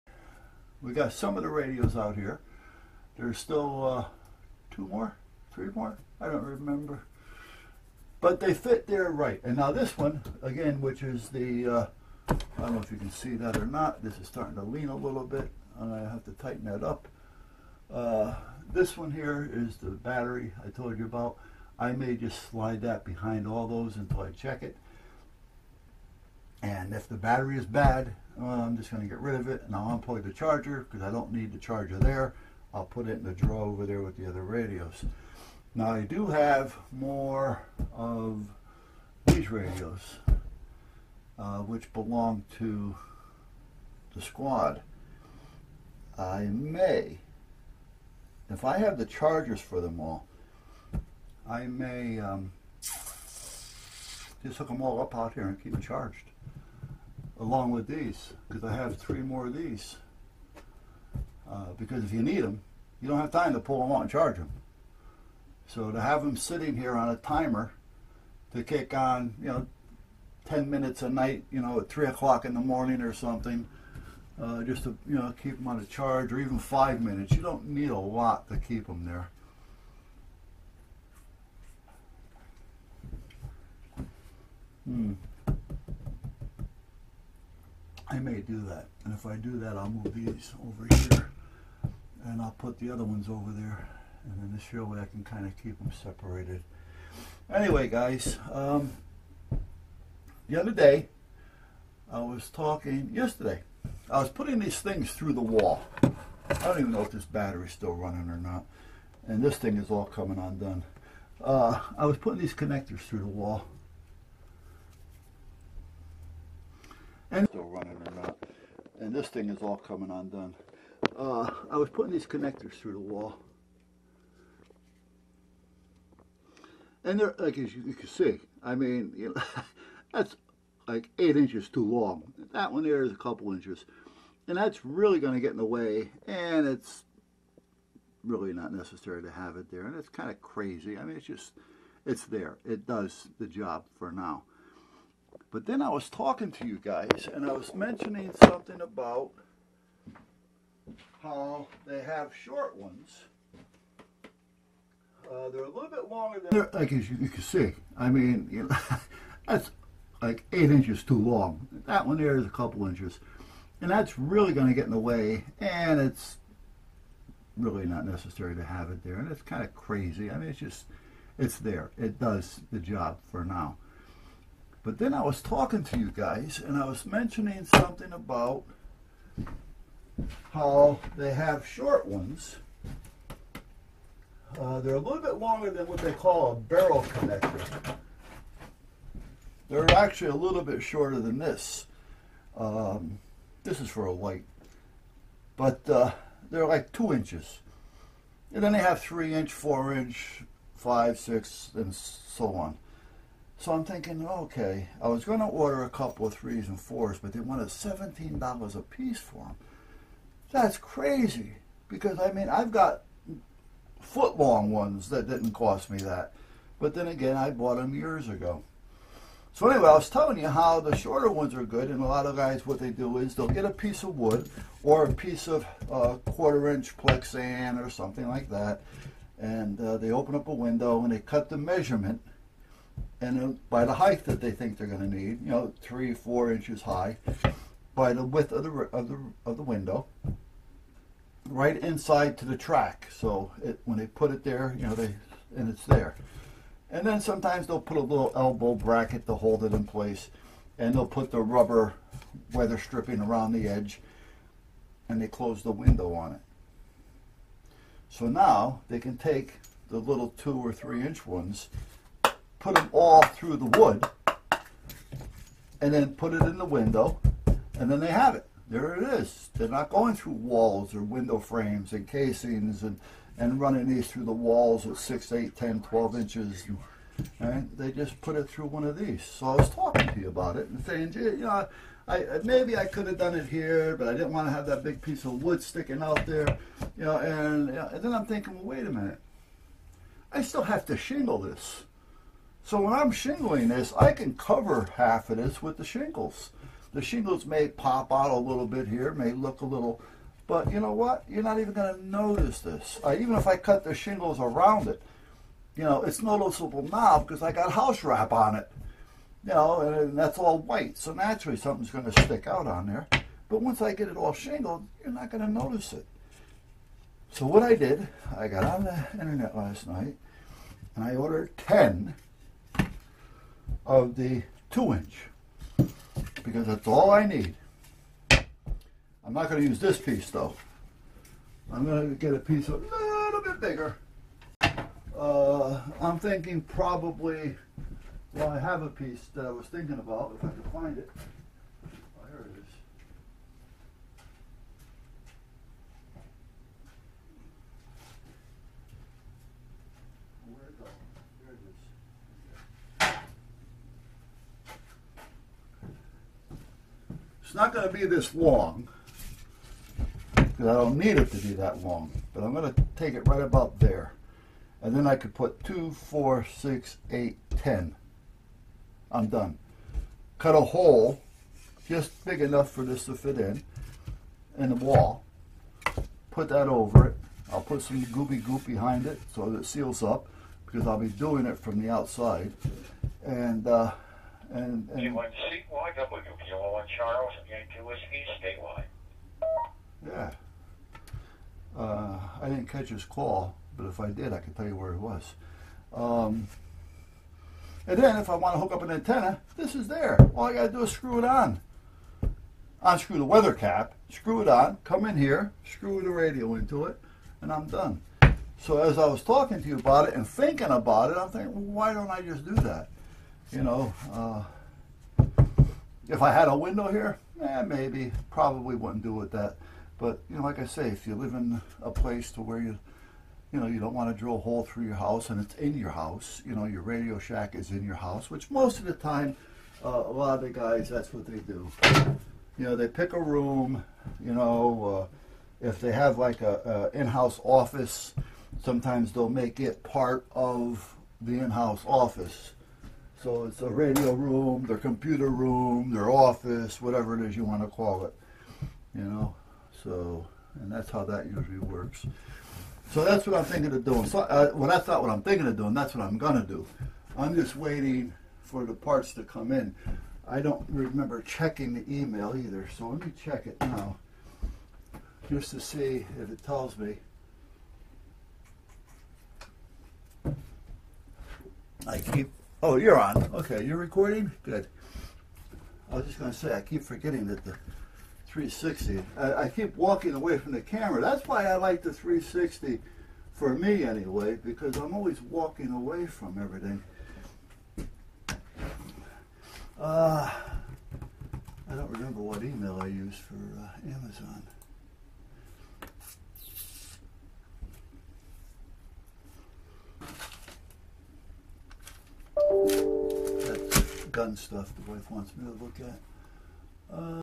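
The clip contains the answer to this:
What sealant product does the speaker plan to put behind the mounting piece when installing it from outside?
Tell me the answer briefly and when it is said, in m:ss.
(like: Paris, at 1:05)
Goop, at 6:18.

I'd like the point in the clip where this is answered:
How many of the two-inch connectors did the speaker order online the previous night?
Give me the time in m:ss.
5:21.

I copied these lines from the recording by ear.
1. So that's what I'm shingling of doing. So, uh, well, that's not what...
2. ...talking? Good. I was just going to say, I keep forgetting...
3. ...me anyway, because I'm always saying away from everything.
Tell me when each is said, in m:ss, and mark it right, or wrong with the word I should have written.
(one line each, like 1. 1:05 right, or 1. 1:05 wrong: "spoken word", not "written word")
1. 7:32 wrong: "thinking", not "shingling"
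2. 7:53 wrong: "recording", not "talking"
3. 8:03 wrong: "walking", not "saying".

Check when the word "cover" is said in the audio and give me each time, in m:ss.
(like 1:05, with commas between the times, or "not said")
4:54.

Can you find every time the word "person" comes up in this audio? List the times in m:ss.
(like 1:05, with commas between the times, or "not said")
not said.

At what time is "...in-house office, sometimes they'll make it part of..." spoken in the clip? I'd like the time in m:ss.
7:16.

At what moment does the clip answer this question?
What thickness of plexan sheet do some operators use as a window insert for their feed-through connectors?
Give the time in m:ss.
3:46.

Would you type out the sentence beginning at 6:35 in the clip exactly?
Um, and then if I want to hook up an antenna, this is there.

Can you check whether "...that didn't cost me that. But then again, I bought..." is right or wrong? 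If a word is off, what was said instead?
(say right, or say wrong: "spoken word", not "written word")
right.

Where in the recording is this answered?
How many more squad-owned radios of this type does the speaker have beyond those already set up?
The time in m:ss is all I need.
0:58.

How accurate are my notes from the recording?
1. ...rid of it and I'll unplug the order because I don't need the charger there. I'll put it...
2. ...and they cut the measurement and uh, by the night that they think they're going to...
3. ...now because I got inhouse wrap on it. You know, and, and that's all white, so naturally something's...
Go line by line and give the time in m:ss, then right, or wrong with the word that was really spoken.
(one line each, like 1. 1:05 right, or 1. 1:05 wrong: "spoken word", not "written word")
1. 0:29 wrong: "charger", not "order"
2. 3:51 wrong: "height", not "night"
3. 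5:06 wrong: "house", not "inhouse".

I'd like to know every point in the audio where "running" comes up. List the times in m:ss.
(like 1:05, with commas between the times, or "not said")
1:47, 1:57, 4:33.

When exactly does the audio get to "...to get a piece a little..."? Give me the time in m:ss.
5:32.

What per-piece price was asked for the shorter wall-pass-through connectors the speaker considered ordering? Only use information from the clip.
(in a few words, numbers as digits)
$17.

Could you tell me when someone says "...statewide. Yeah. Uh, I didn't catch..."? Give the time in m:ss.
6:28.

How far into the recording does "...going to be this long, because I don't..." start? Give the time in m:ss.
5:57.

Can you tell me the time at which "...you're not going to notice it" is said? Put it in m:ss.
5:15.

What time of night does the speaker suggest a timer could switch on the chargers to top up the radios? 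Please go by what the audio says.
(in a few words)
3 o'clock in the morning.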